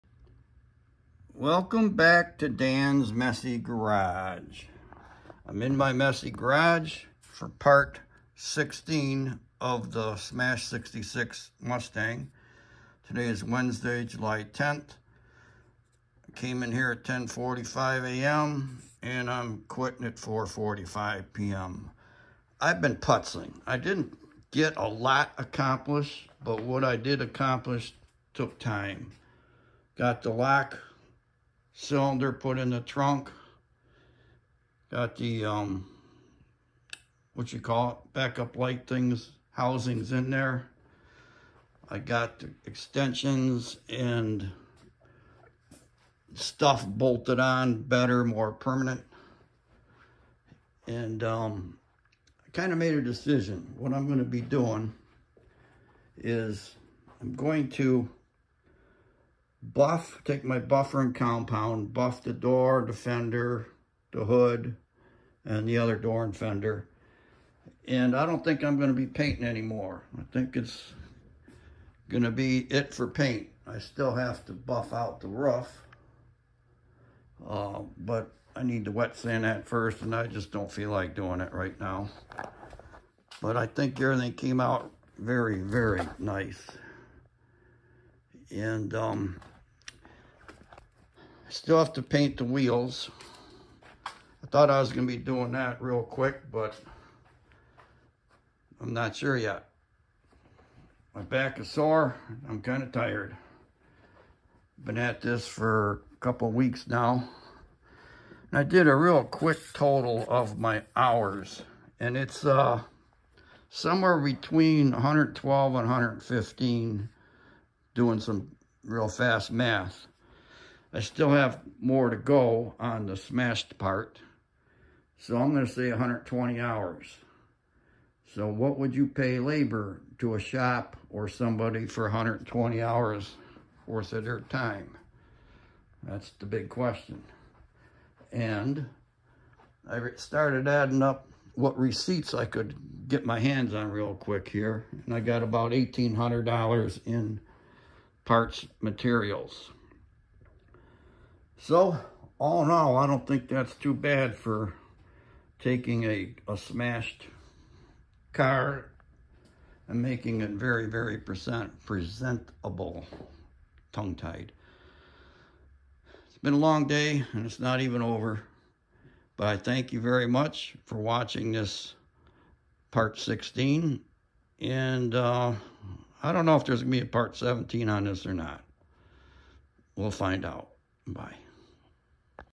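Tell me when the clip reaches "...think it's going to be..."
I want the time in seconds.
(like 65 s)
70 s.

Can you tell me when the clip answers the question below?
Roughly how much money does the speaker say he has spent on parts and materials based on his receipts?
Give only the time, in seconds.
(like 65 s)
145 s.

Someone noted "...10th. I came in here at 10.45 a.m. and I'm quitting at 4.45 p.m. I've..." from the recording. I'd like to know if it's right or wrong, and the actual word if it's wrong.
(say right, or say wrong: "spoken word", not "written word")
right.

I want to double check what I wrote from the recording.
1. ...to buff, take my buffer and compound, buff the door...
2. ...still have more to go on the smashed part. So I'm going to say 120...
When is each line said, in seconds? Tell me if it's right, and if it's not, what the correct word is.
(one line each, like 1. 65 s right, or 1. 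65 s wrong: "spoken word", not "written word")
1. 57 s right
2. 120 s right.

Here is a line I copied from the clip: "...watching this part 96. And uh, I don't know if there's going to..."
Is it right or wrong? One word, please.
wrong.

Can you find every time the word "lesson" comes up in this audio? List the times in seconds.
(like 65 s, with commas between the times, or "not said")
not said.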